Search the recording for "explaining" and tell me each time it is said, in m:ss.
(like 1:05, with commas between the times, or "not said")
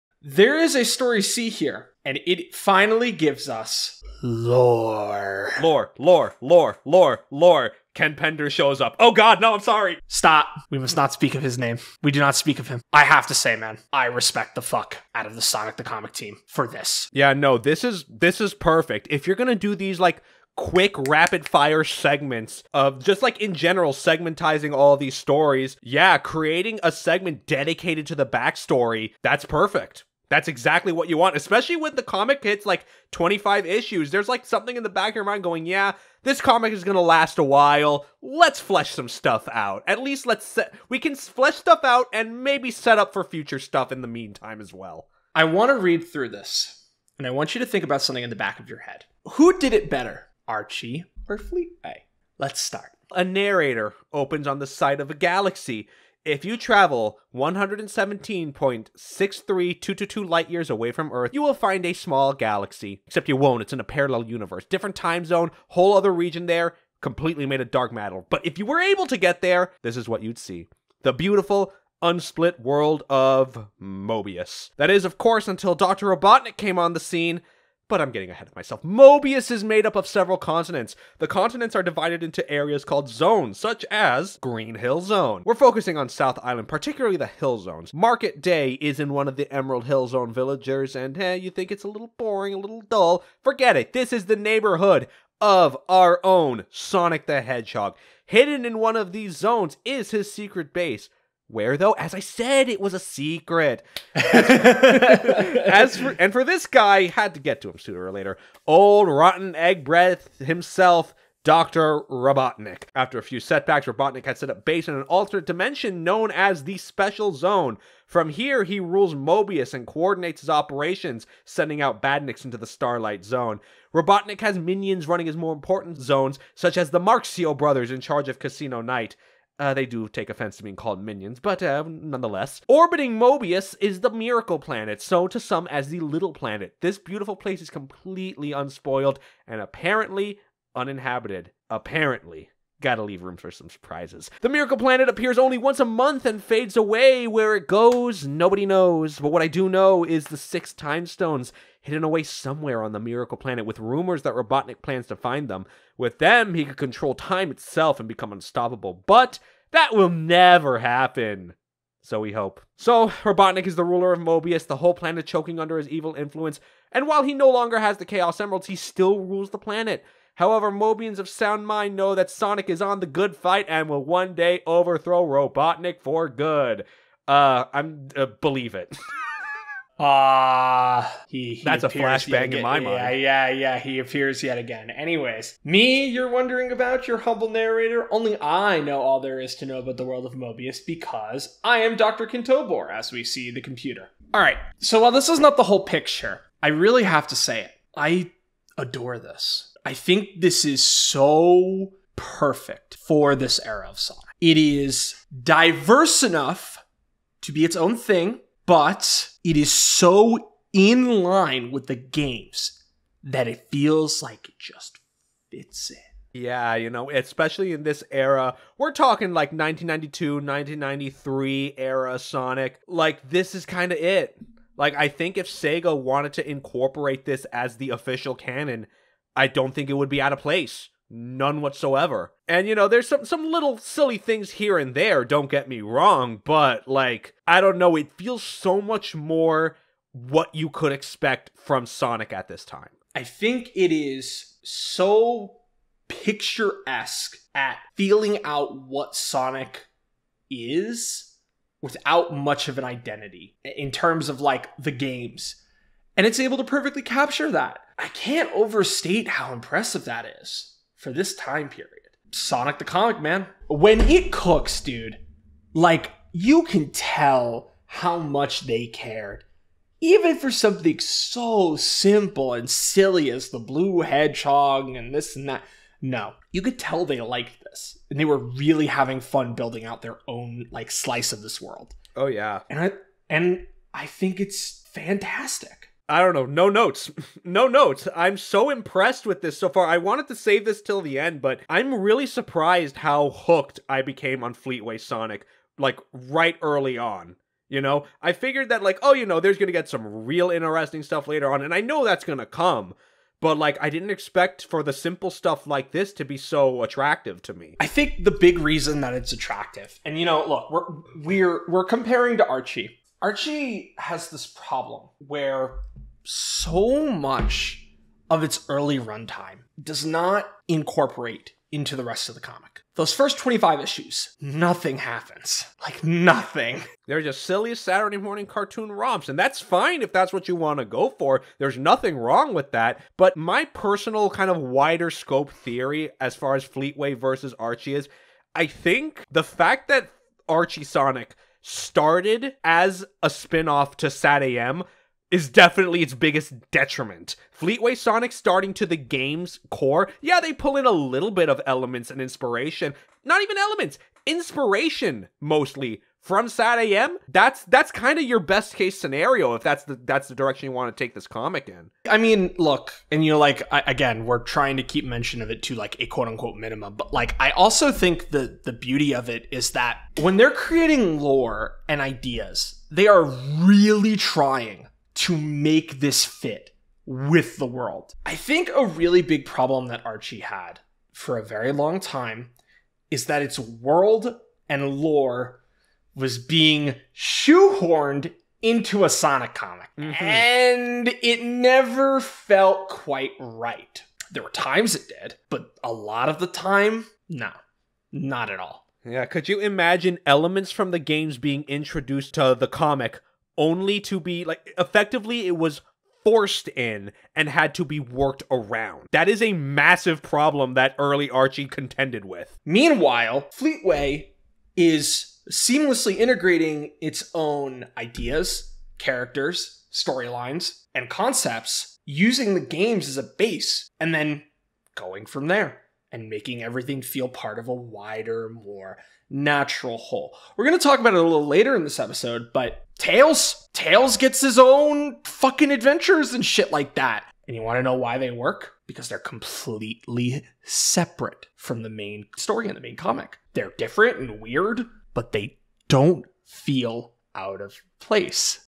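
not said.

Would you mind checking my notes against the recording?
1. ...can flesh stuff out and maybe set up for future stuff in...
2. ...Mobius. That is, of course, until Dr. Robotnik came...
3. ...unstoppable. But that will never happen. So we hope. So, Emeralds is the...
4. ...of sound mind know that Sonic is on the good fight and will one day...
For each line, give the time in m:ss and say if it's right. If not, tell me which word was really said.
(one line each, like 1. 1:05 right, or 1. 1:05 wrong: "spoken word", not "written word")
1. 0:40 right
2. 1:13 right
3. 2:38 wrong: "Robotnik", not "Emeralds"
4. 2:51 right.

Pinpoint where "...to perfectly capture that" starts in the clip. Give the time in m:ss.
4:16.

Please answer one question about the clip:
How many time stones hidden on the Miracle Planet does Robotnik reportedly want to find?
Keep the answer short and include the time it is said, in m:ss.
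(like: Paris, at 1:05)
6, at 2:30.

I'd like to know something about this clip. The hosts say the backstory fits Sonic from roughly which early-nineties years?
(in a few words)
1992, 1993.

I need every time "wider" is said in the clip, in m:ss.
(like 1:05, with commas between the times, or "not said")
5:34, 7:07.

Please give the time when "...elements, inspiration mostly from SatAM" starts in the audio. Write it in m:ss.
5:53.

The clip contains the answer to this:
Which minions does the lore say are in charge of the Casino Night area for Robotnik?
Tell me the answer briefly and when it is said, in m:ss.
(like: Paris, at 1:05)
Marxio brothers, at 2:07.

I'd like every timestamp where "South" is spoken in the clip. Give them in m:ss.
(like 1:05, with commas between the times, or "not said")
1:26.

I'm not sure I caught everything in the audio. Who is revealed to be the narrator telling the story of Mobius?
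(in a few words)
Dr. Kintobor.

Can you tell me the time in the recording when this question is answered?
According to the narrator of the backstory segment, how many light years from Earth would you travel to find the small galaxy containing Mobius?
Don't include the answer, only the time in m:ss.
0:57.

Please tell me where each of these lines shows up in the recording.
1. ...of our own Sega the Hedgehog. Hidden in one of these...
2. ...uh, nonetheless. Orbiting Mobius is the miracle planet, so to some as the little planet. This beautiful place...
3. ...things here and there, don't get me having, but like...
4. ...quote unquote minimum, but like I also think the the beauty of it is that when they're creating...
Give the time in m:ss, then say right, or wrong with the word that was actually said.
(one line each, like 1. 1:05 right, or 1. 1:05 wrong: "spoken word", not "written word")
1. 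1:35 wrong: "Sonic", not "Sega"
2. 2:11 right
3. 3:54 wrong: "wrong", not "having"
4. 6:06 right.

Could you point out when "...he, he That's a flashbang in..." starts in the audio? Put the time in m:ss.
3:01.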